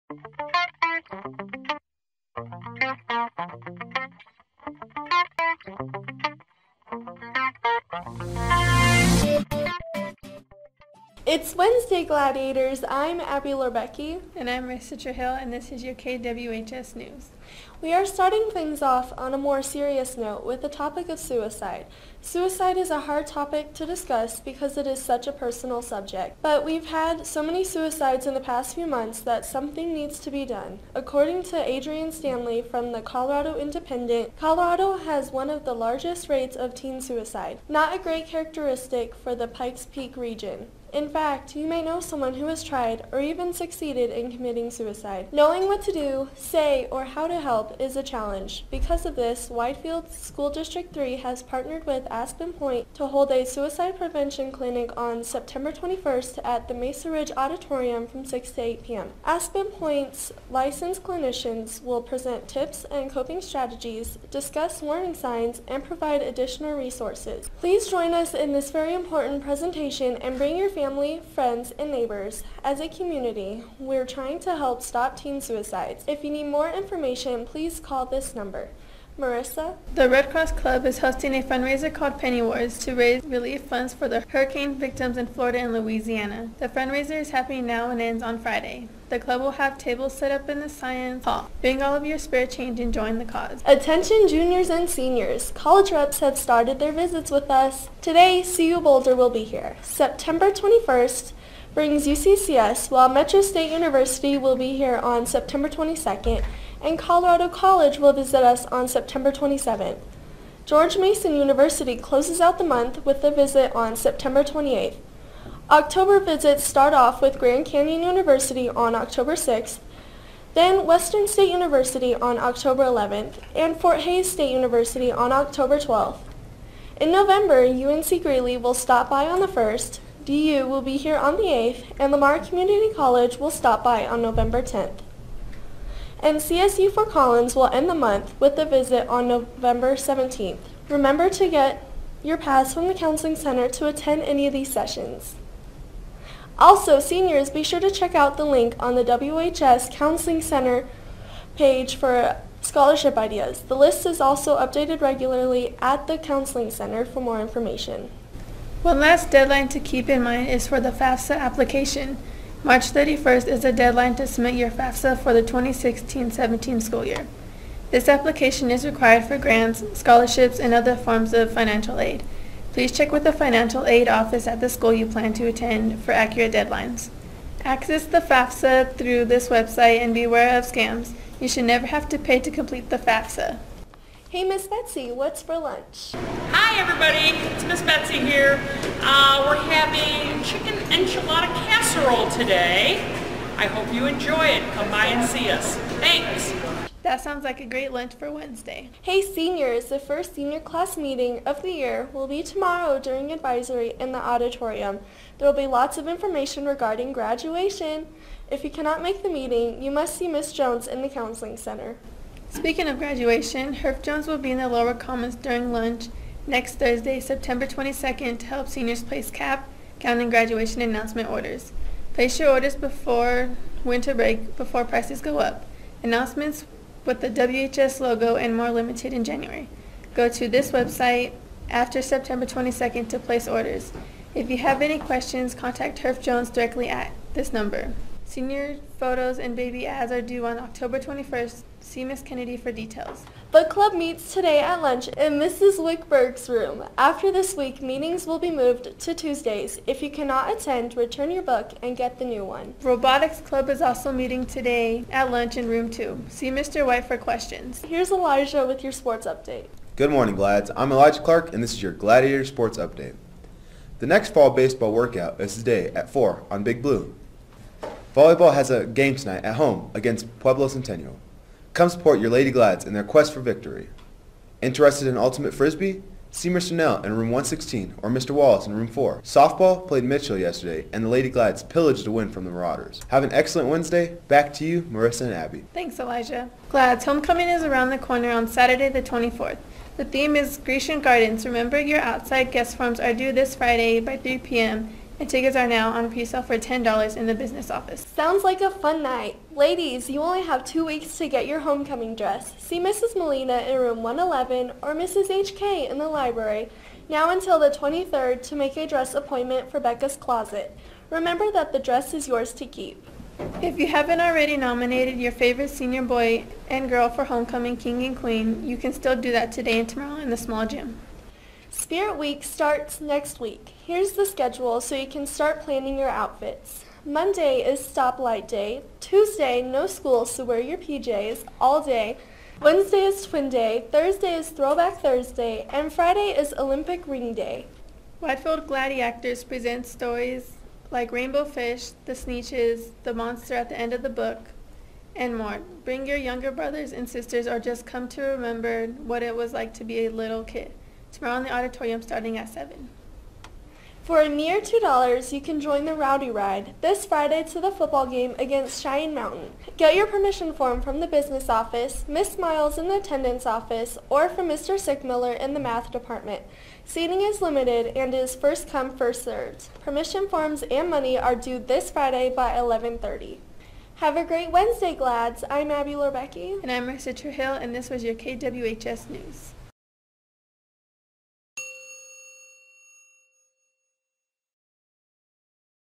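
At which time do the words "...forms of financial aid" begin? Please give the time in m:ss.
2:50.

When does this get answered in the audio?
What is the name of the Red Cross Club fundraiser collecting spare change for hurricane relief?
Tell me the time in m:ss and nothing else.
1:22.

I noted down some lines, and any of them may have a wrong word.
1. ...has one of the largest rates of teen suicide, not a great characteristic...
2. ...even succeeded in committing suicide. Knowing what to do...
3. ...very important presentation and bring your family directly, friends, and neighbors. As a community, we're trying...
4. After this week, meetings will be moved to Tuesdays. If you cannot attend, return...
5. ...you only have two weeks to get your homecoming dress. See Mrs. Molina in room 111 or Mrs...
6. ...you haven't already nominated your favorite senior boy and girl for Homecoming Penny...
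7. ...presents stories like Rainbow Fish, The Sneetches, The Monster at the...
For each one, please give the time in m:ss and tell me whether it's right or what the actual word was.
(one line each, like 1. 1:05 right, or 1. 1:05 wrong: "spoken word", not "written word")
1. 0:34 right
2. 0:43 right
3. 1:08 wrong: "family", not "directly"
4. 4:06 right
5. 5:00 right
6. 5:13 wrong: "King", not "Penny"
7. 5:39 right.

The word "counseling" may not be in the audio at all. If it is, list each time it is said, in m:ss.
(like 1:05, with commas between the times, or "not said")
2:22, 2:29, 2:36, 3:31.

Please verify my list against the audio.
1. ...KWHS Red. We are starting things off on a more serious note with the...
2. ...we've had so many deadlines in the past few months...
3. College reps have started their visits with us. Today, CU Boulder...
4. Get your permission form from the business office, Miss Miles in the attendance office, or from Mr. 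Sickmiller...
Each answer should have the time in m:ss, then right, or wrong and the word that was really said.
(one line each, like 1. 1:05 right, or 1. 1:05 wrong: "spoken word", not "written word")
1. 0:15 wrong: "News", not "Red"
2. 0:26 wrong: "suicides", not "deadlines"
3. 1:35 right
4. 5:59 right.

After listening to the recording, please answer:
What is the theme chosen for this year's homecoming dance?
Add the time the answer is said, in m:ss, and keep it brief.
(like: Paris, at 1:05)
Grecian Gardens, at 4:50.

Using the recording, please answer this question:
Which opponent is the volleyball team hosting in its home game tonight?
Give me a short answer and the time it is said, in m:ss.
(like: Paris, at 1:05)
Pueblo Centennial, at 4:30.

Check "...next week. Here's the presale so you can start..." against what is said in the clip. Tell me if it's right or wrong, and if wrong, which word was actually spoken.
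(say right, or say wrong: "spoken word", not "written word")
wrong: "schedule", not "presale".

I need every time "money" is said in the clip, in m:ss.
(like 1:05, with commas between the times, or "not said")
6:10.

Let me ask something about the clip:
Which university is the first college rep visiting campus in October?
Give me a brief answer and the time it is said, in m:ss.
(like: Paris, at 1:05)
Grand Canyon University, at 1:57.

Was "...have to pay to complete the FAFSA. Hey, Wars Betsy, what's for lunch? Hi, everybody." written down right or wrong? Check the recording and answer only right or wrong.
wrong.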